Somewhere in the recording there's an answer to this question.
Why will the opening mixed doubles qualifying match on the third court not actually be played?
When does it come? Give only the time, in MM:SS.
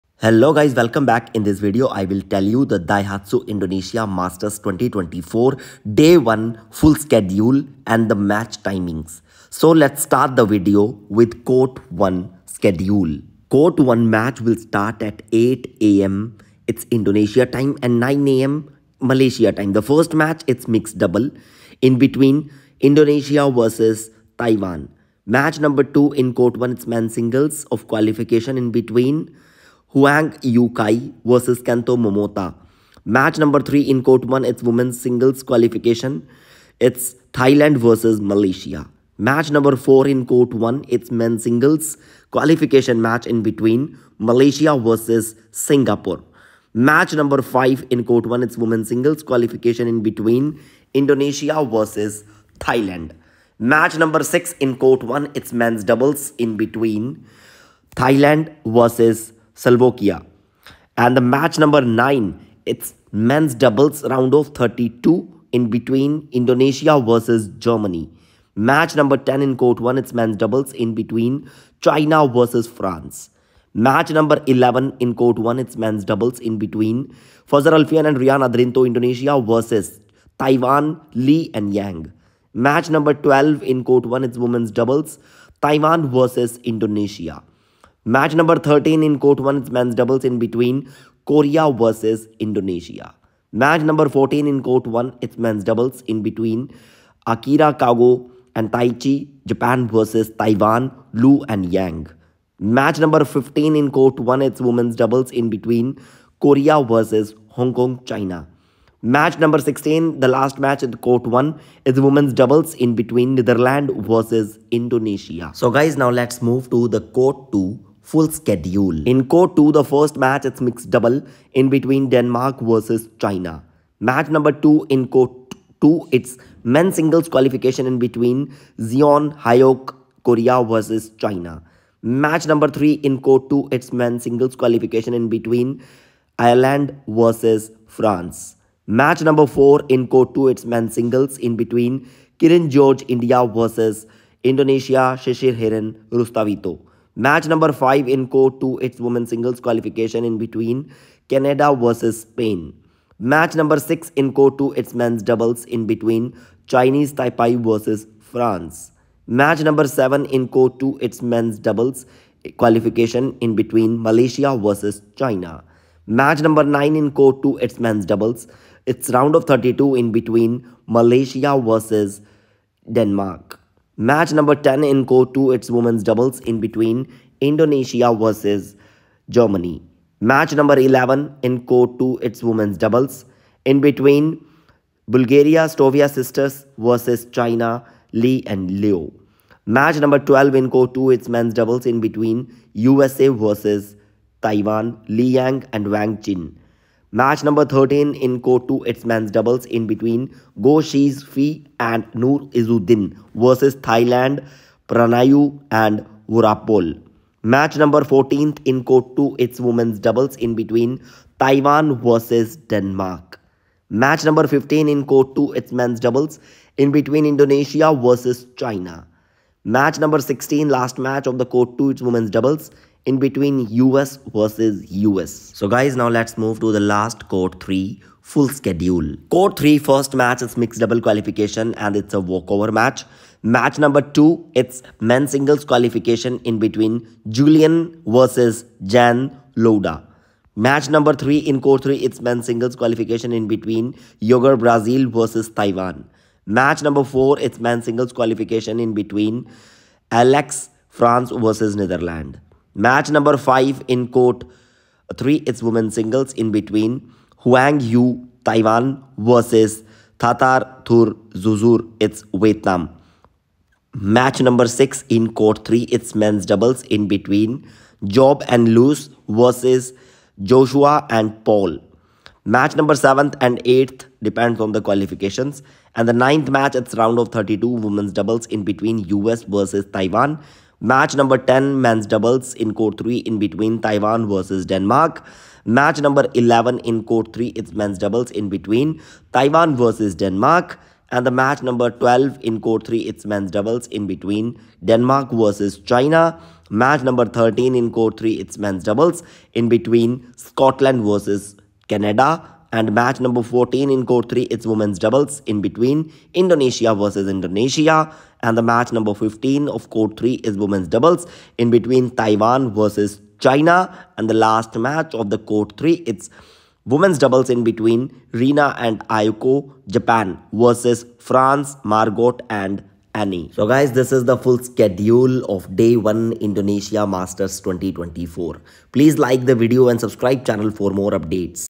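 03:52.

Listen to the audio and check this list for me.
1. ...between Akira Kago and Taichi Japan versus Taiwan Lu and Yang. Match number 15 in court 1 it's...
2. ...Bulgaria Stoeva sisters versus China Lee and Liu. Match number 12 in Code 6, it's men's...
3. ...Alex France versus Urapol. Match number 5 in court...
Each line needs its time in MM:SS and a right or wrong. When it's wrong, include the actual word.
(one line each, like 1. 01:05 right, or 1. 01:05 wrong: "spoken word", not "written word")
1. 01:36 right
2. 03:05 wrong: "2", not "6"
3. 04:10 wrong: "Netherlands", not "Urapol".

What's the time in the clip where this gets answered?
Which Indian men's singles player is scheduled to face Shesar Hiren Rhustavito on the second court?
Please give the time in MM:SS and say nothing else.
02:22.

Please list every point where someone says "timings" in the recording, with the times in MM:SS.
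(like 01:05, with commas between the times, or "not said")
00:08.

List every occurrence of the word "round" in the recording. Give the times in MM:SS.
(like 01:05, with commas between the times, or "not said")
01:04, 02:49, 04:36.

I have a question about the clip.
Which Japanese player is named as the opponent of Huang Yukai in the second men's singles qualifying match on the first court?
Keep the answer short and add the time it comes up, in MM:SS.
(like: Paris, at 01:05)
Kento Momota, at 00:31.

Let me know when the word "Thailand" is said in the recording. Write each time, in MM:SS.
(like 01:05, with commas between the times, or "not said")
00:37, 00:52, 00:57, 03:23.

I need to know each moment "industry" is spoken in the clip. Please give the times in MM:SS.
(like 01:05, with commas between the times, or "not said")
not said.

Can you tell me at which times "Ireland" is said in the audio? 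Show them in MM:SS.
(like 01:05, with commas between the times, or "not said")
02:16.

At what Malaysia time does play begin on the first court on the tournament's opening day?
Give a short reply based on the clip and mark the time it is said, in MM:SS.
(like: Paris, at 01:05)
9 a.m., at 00:17.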